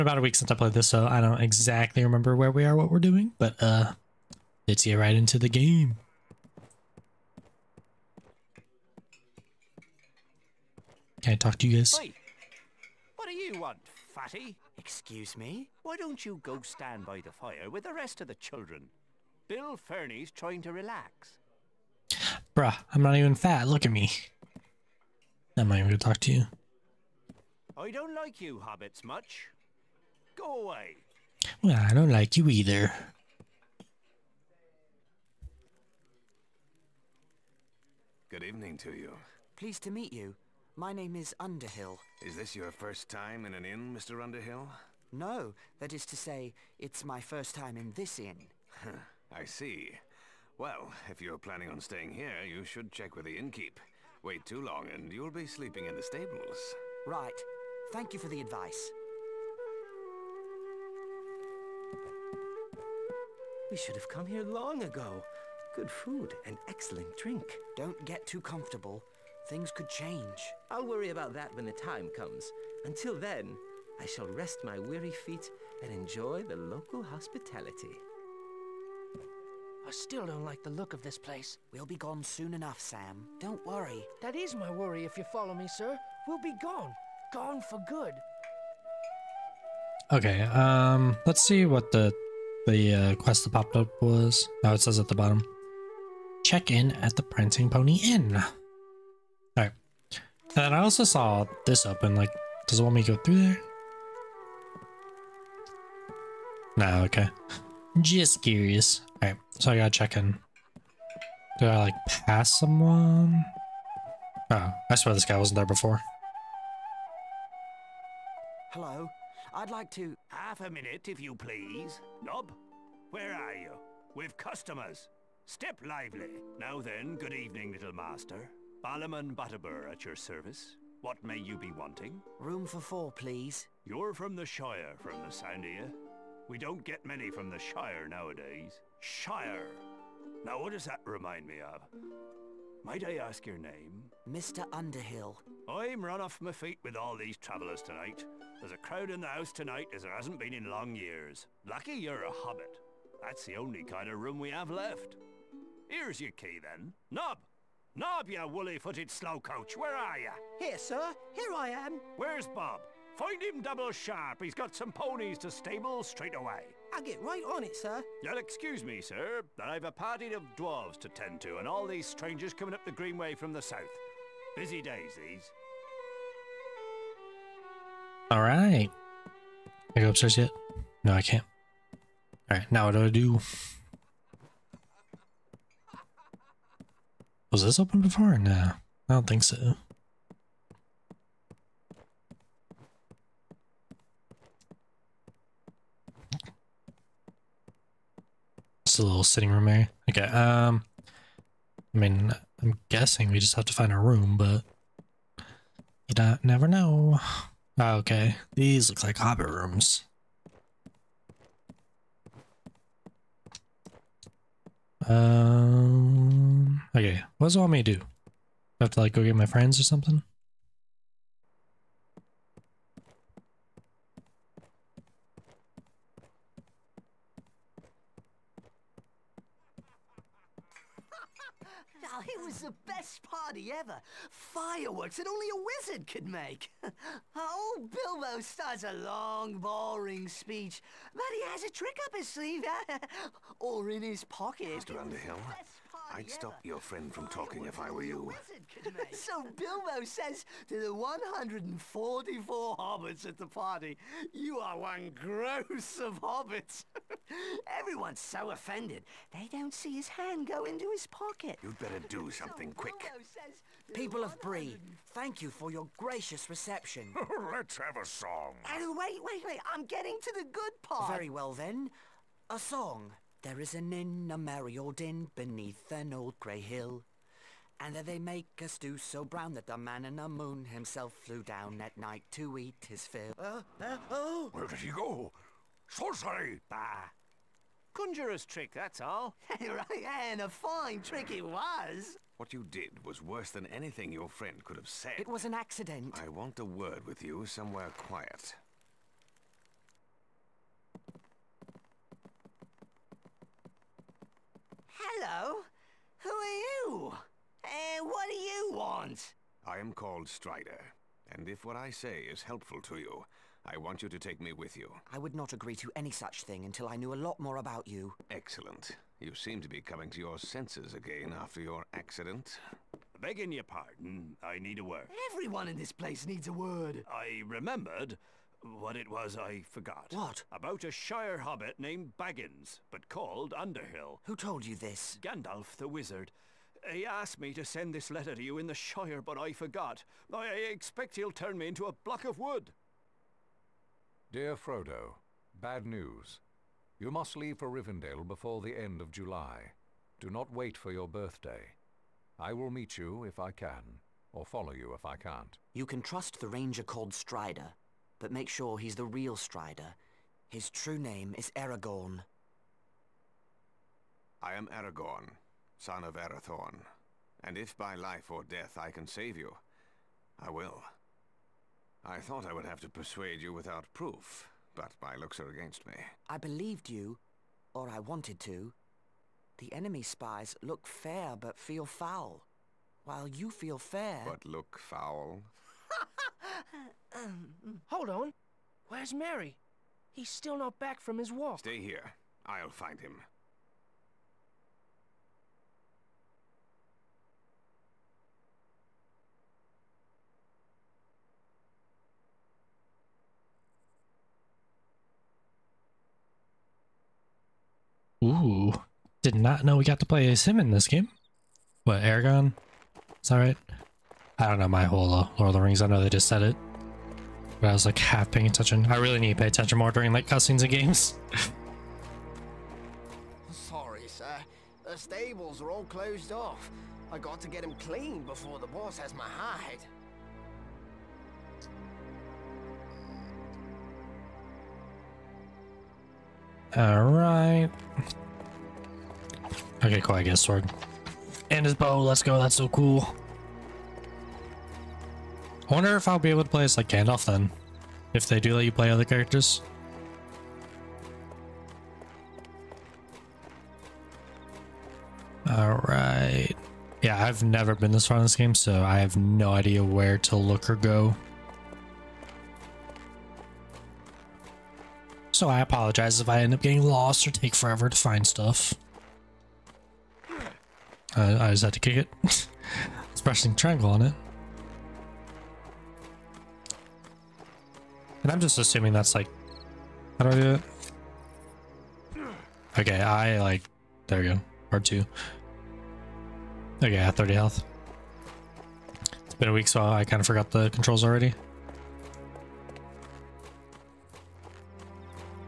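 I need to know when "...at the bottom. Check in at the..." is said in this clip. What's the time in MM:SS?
01:34.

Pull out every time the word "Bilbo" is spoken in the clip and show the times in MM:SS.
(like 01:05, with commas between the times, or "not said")
03:57, 04:09.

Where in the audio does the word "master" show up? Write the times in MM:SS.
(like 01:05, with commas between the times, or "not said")
02:07.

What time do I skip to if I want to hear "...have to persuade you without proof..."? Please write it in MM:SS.
06:12.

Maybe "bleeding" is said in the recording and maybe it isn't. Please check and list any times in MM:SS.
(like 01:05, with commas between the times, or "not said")
not said.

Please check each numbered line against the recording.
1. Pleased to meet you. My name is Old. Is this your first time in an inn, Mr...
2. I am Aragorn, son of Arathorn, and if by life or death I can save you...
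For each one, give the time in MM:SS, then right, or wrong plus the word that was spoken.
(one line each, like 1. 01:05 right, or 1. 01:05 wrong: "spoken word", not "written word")
1. 00:39 wrong: "Underhill", not "Old"
2. 06:04 right.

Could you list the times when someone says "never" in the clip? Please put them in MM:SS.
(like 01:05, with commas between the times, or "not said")
03:26, 07:37.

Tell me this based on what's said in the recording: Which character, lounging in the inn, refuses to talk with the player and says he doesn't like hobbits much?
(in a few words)
Bill Ferny.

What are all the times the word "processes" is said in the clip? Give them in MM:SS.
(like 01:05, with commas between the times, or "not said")
not said.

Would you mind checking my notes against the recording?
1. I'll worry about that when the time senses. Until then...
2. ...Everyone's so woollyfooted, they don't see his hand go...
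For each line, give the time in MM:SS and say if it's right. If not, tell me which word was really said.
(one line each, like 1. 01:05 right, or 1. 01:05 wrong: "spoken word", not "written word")
1. 01:10 wrong: "comes", not "senses"
2. 04:17 wrong: "offended", not "woollyfooted".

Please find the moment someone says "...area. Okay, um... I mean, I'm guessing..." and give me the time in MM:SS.
03:19.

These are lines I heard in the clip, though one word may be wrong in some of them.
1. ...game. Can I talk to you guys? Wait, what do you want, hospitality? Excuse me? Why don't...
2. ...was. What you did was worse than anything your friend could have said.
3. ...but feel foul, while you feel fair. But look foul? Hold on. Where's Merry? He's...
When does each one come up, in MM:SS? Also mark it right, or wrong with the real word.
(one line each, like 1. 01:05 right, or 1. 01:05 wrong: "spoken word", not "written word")
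1. 00:05 wrong: "fatty", not "hospitality"
2. 04:51 right
3. 06:21 right.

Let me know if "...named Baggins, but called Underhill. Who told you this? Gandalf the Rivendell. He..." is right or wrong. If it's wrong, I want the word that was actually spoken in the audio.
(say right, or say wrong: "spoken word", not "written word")
wrong: "Wizard", not "Rivendell".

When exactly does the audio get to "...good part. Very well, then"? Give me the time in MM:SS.
04:30.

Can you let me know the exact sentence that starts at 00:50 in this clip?
Well, if you're planning on staying here, you should check with the innkeep.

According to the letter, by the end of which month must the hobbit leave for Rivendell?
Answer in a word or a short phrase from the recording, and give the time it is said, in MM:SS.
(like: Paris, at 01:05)
July, at 05:49.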